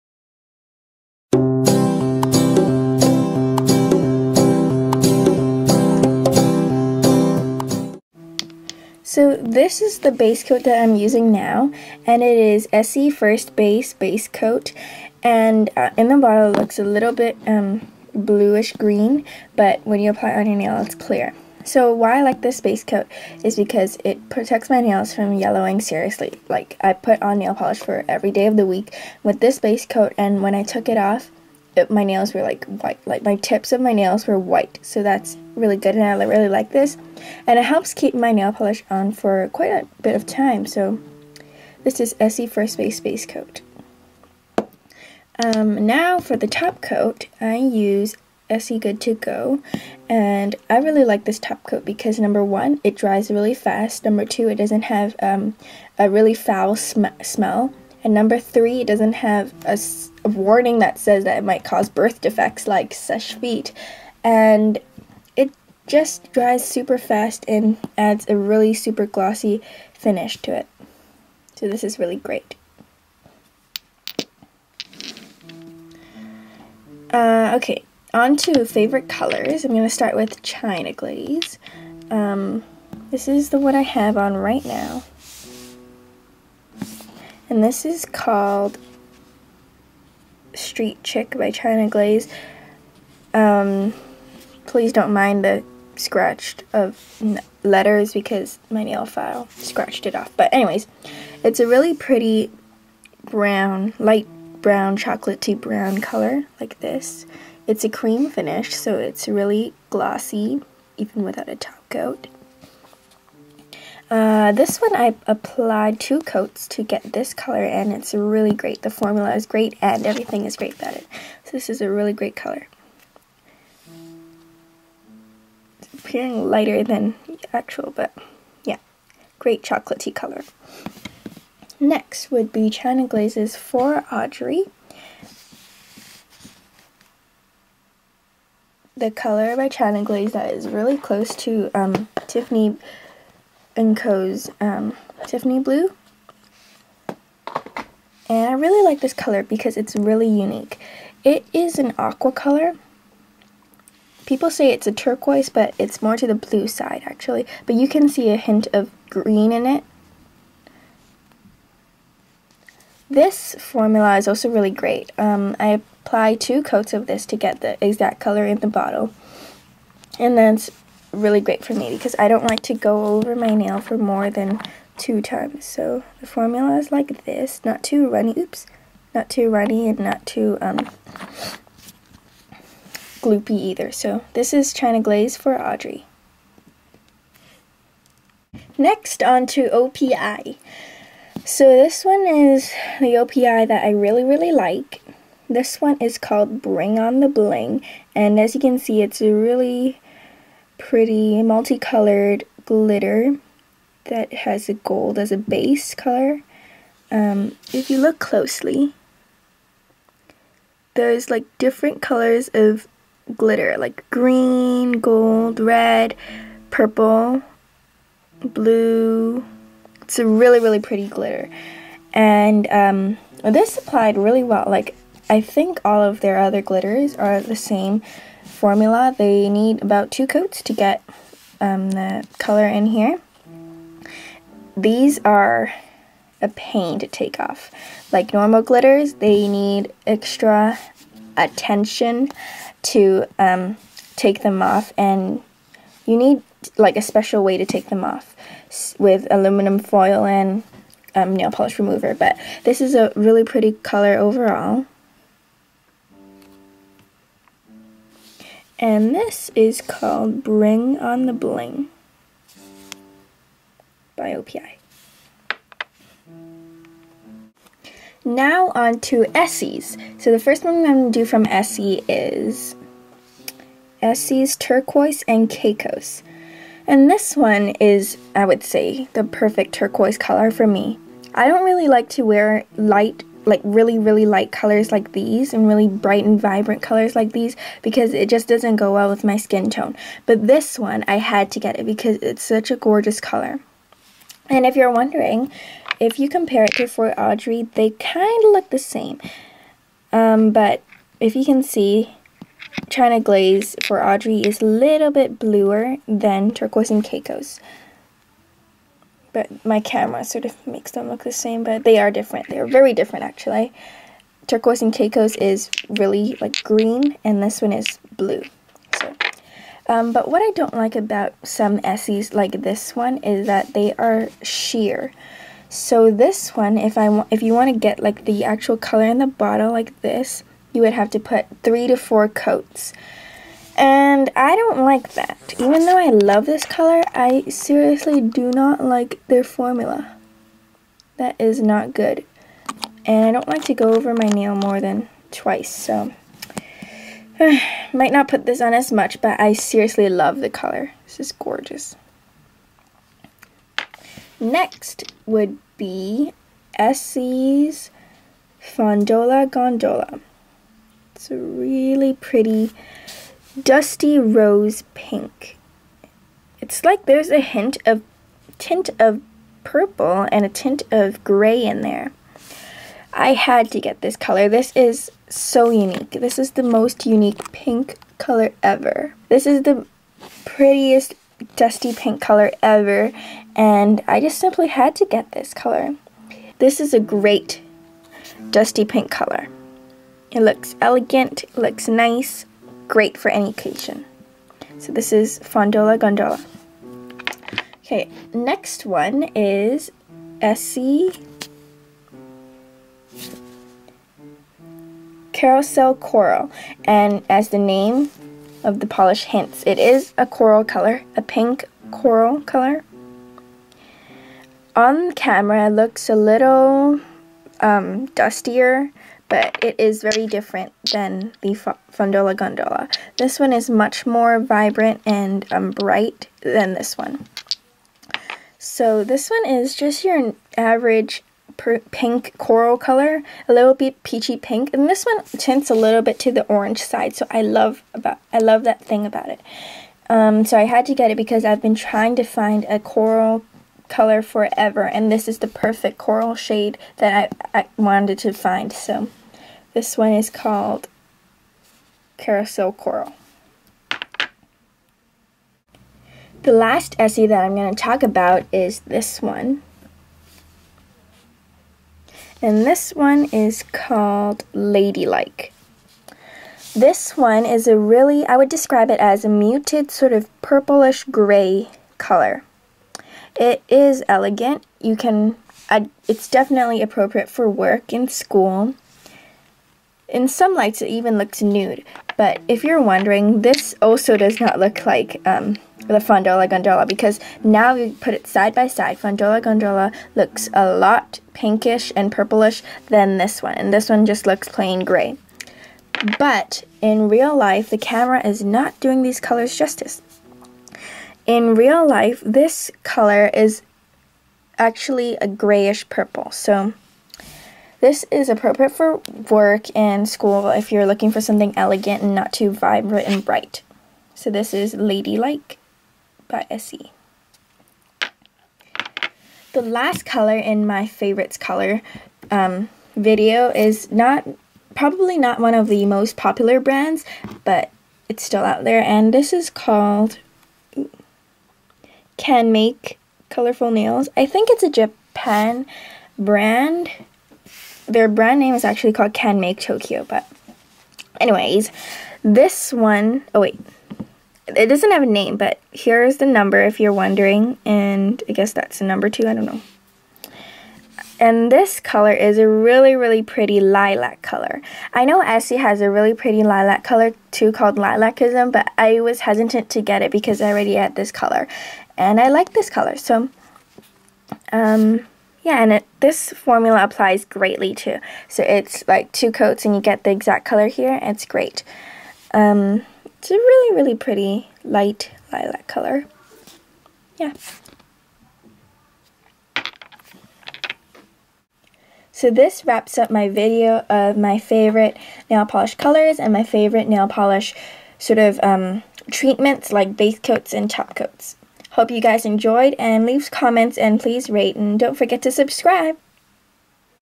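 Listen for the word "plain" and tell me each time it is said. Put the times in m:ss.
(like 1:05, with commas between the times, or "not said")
8:14.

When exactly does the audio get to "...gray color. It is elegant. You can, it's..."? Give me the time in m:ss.
7:51.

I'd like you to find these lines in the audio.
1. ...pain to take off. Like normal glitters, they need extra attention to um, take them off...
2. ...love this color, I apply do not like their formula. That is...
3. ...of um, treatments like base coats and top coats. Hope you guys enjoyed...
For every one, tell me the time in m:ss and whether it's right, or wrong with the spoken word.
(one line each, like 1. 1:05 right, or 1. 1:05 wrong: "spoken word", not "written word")
1. 3:56 right
2. 5:36 wrong: "seriously", not "apply"
3. 9:48 right.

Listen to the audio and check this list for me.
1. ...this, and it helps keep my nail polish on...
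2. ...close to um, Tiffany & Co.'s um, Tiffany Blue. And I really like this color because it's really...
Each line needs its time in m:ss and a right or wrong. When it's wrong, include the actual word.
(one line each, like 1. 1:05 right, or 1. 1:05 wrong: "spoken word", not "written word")
1. 0:36 right
2. 2:20 right.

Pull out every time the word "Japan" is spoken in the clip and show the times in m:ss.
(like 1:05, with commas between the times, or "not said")
8:54.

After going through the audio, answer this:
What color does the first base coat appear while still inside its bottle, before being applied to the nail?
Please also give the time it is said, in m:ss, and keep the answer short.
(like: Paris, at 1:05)
bluish green, at 0:18.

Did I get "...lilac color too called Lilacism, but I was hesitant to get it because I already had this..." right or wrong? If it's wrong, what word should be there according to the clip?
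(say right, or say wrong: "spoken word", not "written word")
right.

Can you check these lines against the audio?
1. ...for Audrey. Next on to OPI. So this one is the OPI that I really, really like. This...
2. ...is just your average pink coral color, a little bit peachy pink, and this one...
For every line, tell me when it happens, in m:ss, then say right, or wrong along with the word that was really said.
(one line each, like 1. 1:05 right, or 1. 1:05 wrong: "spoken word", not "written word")
1. 3:05 right
2. 7:09 right.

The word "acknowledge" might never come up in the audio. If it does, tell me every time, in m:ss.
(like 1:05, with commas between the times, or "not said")
not said.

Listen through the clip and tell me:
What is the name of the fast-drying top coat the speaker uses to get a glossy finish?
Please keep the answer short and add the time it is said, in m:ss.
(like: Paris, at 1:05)
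Essie Good To Go, at 0:48.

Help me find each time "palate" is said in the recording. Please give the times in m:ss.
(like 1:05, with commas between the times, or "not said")
not said.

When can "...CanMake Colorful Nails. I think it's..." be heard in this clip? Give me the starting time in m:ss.
8:52.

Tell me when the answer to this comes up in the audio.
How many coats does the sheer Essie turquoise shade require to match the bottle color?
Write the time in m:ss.
5:31.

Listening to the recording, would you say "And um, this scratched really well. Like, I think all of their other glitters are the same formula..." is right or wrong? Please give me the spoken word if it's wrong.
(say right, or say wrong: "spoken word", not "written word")
wrong: "applied", not "scratched".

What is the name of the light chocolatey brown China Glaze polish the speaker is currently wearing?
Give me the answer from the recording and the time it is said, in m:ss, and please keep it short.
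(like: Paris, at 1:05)
Street Chic, at 1:30.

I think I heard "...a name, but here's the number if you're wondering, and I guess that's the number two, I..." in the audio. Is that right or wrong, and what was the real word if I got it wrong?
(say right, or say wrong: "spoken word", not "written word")
right.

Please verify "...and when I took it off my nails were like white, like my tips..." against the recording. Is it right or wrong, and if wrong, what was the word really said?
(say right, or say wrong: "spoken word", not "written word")
right.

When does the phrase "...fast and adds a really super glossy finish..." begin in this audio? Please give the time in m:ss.
1:06.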